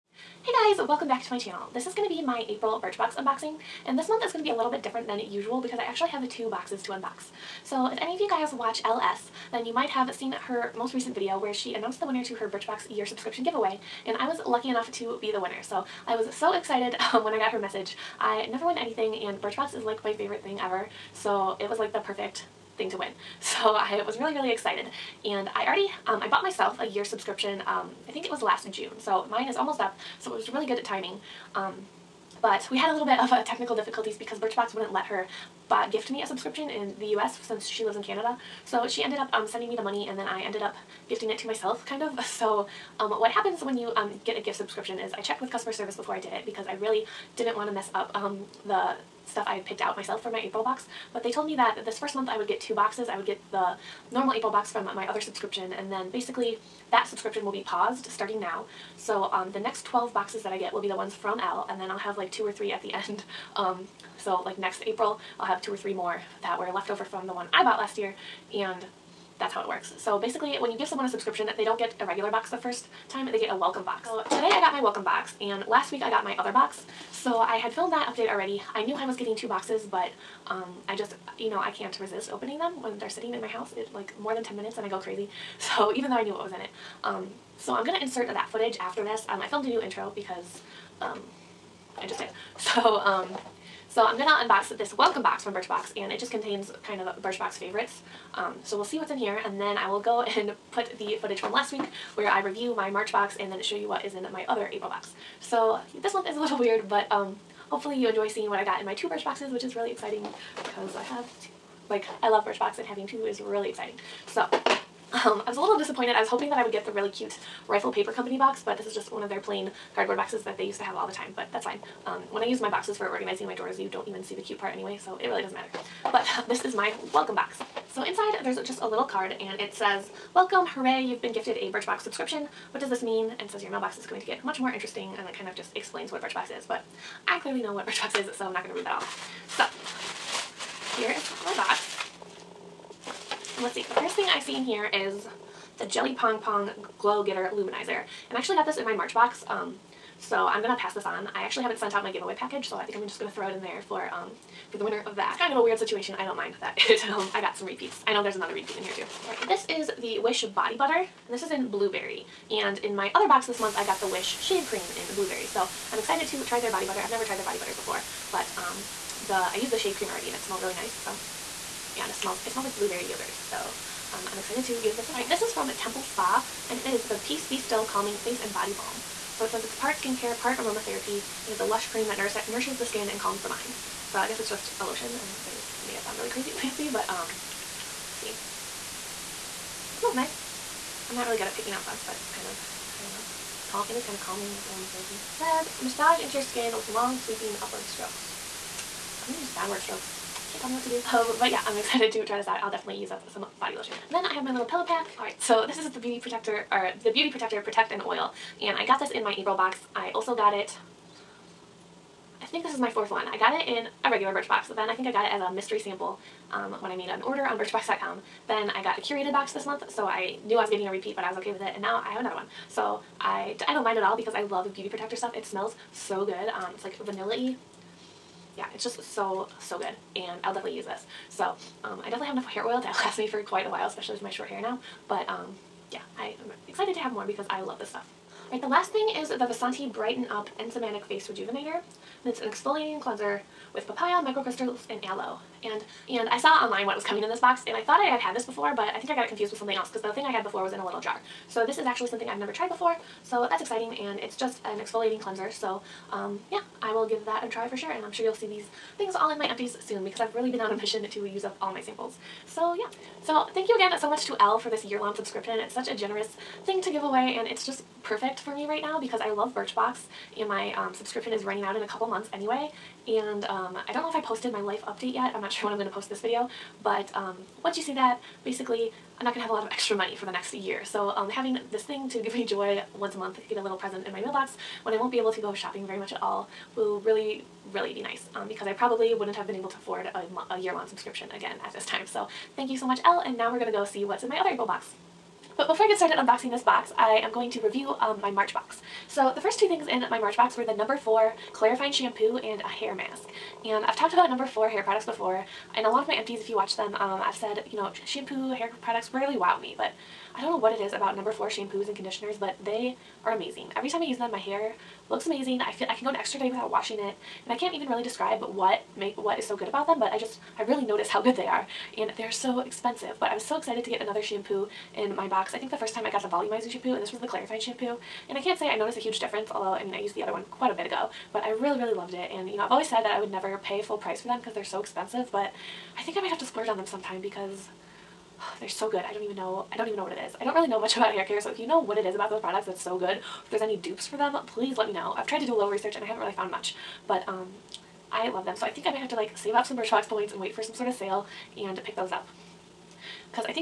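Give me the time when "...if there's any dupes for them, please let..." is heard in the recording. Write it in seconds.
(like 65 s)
343 s.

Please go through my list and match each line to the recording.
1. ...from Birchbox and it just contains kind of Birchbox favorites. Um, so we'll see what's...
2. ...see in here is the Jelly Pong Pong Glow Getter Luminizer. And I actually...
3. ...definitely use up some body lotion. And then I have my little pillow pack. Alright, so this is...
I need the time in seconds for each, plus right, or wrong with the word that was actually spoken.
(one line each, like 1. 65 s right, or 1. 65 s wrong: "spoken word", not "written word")
1. 95 s right
2. 144 s right
3. 202 s right.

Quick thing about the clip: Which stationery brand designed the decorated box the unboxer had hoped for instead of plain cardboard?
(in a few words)
Rifle Paper Company.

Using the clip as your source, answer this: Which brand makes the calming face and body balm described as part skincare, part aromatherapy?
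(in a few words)
Temple Spa.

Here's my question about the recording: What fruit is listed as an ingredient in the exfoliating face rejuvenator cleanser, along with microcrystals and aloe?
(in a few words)
Papaya.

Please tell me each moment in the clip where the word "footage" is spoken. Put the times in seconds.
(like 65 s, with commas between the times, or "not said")
88 s, 101 s.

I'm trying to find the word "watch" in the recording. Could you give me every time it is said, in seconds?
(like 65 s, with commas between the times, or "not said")
8 s, 306 s.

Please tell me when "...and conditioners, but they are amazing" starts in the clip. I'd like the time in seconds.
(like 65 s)
311 s.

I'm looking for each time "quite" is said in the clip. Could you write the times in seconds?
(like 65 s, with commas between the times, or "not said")
233 s, 330 s.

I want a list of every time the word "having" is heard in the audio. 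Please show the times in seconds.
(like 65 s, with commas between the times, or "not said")
112 s, 281 s.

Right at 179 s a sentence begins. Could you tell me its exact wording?
So it says it's part skincare, part aromatherapy.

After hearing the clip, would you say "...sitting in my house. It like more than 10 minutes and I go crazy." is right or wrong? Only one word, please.
right.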